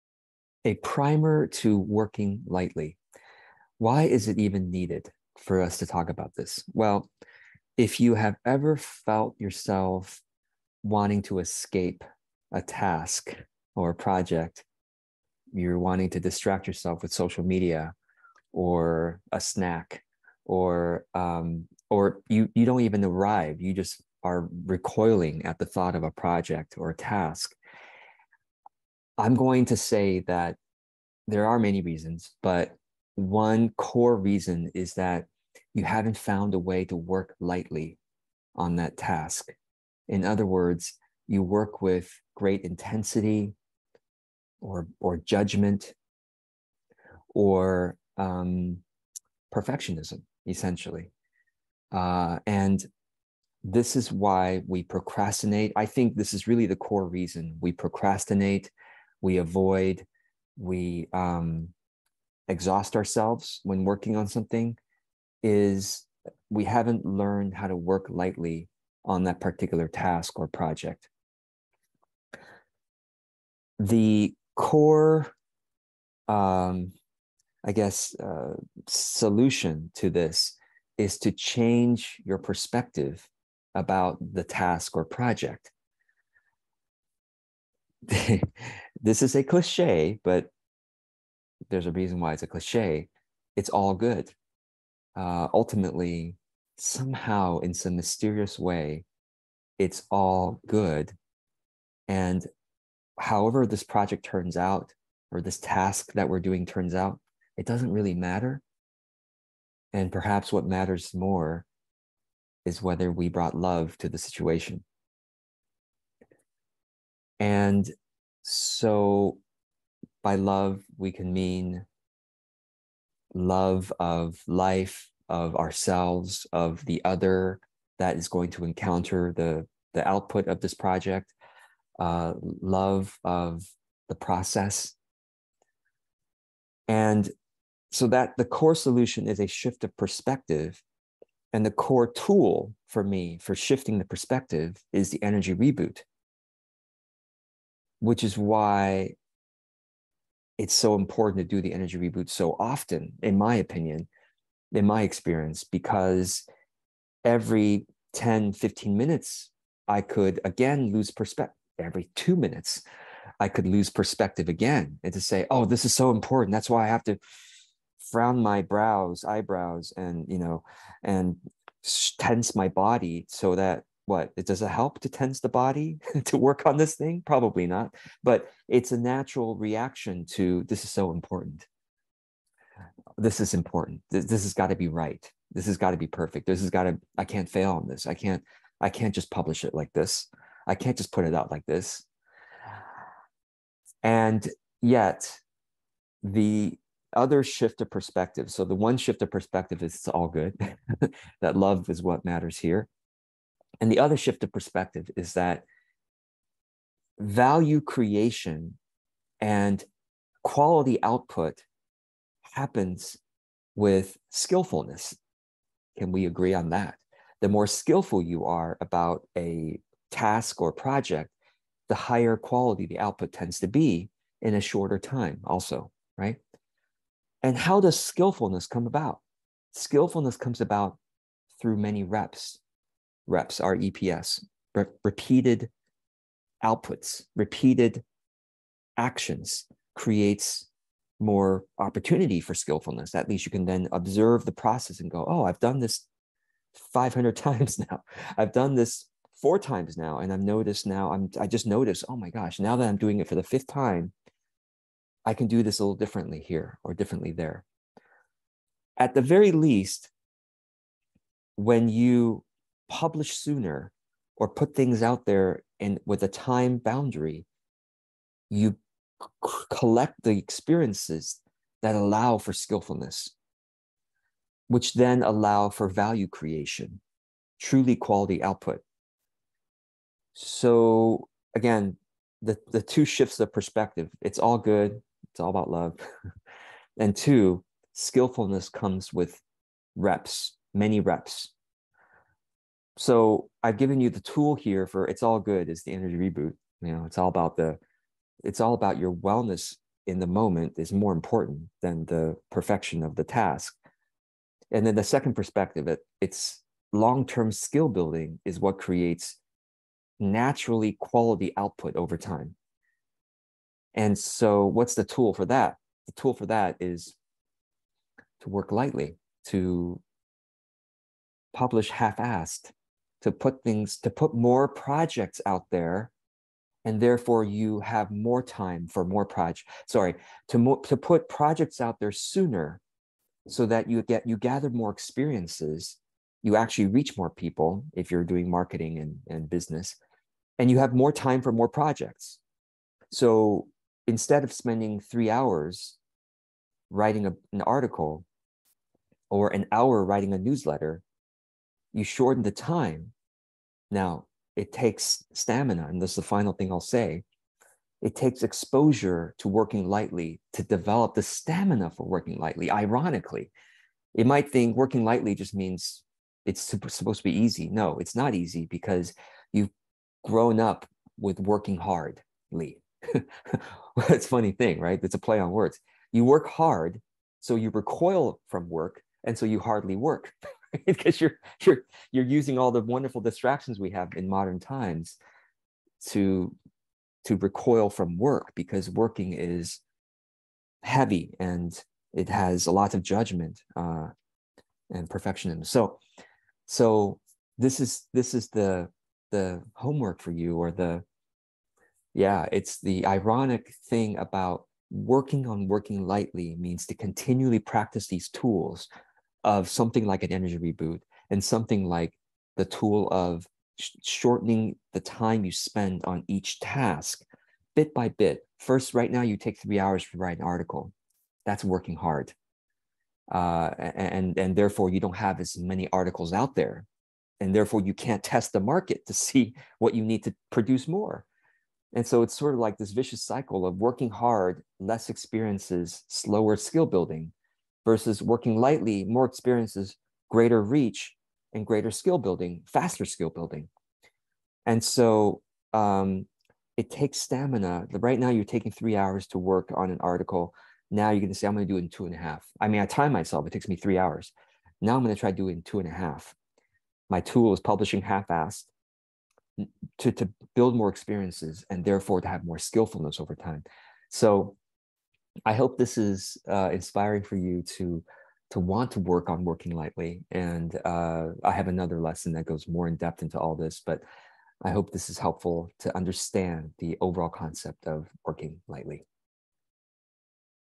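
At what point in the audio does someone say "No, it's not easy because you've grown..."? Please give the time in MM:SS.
06:07.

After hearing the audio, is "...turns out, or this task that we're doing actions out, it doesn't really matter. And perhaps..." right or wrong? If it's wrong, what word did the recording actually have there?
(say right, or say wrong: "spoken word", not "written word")
wrong: "turns", not "actions".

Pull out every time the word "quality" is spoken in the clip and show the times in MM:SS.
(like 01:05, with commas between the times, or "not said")
03:30, 03:42, 04:37, 05:10.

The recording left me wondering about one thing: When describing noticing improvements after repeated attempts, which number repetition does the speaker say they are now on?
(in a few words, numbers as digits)
fifth.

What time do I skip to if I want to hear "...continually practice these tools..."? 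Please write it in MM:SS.
06:46.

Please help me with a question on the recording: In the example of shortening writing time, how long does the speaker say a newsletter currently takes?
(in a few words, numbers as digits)
an hour.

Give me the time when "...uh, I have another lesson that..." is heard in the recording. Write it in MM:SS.
07:50.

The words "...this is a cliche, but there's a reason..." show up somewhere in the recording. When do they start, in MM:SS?
01:29.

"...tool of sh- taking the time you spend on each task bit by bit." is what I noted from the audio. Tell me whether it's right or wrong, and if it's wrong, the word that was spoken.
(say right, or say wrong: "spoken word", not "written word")
wrong: "shortening", not "taking".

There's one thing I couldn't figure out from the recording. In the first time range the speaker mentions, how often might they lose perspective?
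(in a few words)
10 to 15 minutes.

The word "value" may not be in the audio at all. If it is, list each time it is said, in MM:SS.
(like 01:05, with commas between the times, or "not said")
03:27, 04:35.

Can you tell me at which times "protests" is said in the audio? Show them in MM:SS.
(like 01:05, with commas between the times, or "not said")
not said.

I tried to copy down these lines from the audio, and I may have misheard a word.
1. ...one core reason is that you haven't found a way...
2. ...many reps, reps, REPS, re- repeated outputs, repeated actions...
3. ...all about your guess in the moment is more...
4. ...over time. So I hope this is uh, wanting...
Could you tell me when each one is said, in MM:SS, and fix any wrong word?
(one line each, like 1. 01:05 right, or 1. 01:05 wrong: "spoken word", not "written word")
1. 00:33 right
2. 03:51 right
3. 04:58 wrong: "wellness", not "guess"
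4. 07:43 wrong: "inspiring", not "wanting".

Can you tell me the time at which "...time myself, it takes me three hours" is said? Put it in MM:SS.
07:32.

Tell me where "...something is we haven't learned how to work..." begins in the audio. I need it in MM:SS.
01:04.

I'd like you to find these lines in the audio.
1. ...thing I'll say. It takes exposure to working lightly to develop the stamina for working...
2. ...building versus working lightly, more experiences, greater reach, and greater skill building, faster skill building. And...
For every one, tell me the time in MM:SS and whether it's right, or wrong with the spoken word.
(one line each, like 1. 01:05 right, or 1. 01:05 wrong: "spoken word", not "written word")
1. 05:56 right
2. 07:16 right.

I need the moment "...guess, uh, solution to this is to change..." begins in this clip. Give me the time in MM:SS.
01:17.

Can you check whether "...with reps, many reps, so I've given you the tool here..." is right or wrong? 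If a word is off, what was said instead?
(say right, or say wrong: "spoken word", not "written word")
right.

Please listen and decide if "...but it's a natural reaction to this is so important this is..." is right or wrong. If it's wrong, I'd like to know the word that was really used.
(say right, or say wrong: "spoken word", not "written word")
right.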